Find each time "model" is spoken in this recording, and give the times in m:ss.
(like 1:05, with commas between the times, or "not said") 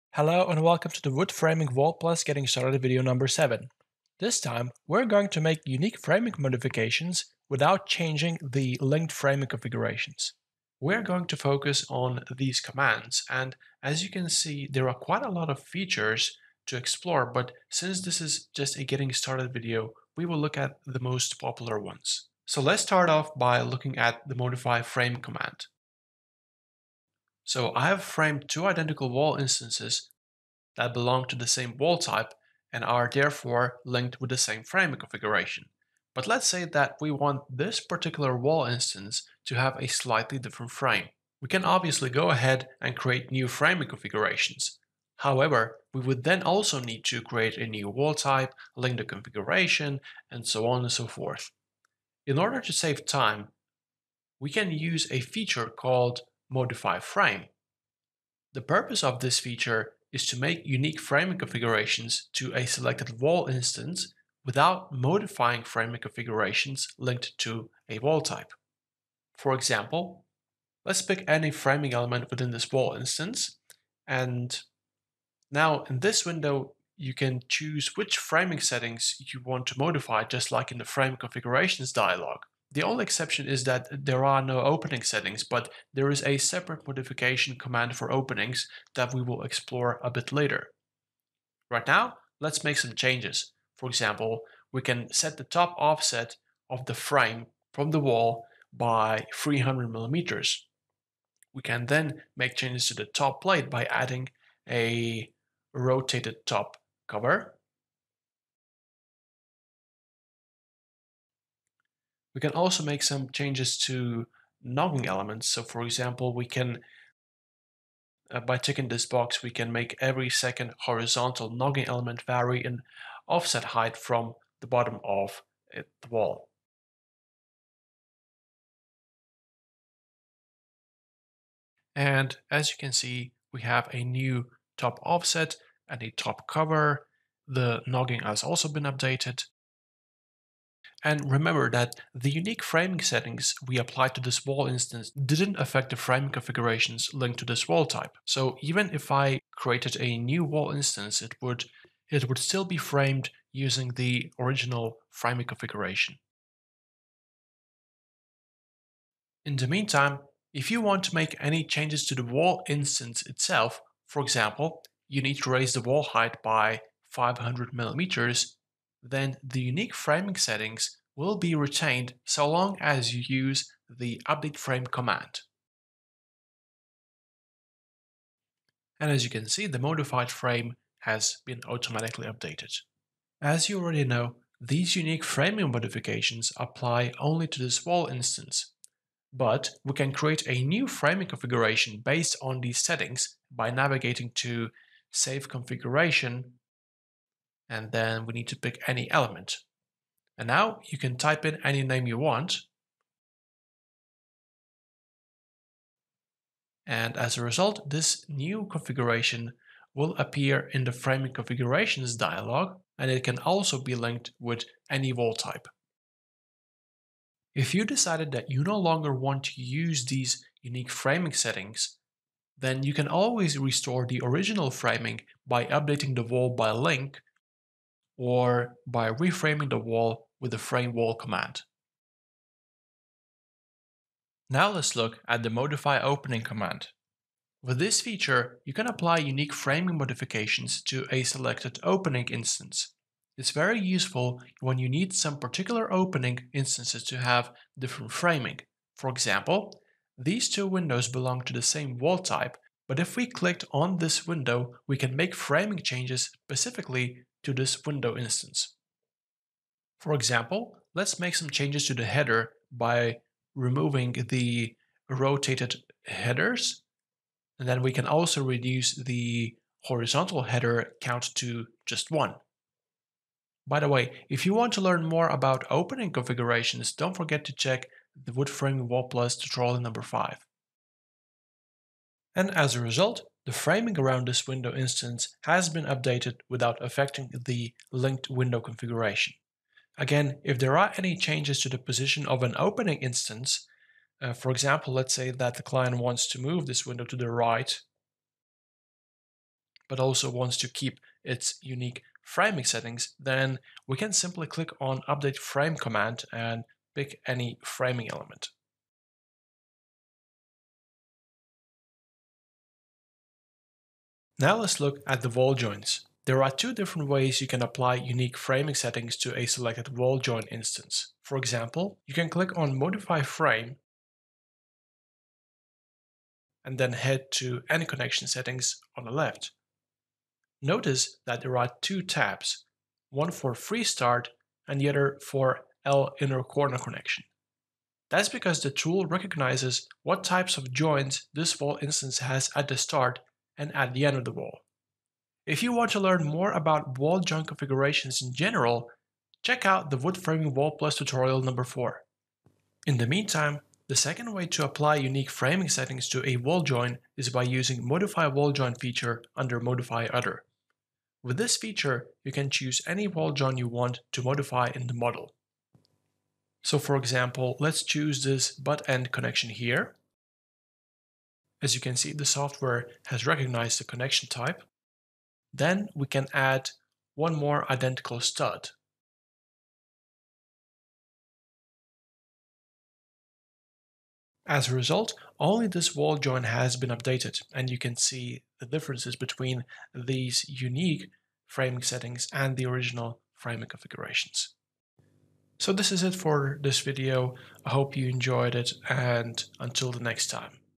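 6:04.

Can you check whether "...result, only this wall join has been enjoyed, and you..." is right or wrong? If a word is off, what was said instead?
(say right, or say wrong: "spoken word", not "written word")
wrong: "updated", not "enjoyed".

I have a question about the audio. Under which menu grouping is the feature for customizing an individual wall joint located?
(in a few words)
Modify Other.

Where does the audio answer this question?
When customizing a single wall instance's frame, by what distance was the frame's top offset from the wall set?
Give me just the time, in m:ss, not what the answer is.
1:39.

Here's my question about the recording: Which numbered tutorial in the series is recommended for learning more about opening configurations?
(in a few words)
5.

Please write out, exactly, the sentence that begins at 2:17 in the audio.
The nogging has also been updated.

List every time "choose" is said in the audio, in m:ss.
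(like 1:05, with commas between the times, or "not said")
1:17, 6:02, 6:07.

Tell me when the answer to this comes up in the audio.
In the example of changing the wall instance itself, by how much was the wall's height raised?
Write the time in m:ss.
2:47.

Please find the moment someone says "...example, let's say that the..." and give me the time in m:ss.
4:54.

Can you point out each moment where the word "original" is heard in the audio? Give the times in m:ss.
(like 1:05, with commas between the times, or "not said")
2:34, 3:44, 6:32.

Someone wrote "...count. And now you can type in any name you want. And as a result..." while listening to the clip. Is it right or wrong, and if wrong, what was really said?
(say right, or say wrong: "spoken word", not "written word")
wrong: "element", not "count".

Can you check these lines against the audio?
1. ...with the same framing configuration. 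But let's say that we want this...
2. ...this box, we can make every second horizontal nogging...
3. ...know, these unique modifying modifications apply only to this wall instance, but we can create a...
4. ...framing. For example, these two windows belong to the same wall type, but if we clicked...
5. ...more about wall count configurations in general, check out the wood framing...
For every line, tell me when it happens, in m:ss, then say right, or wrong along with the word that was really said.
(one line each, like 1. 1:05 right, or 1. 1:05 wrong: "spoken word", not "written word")
1. 0:34 right
2. 1:58 right
3. 3:04 wrong: "framing", not "modifying"
4. 4:08 right
5. 5:46 wrong: "joint", not "count".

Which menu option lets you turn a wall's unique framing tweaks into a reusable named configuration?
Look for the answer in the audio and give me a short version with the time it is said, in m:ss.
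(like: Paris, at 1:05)
Save Configuration, at 3:15.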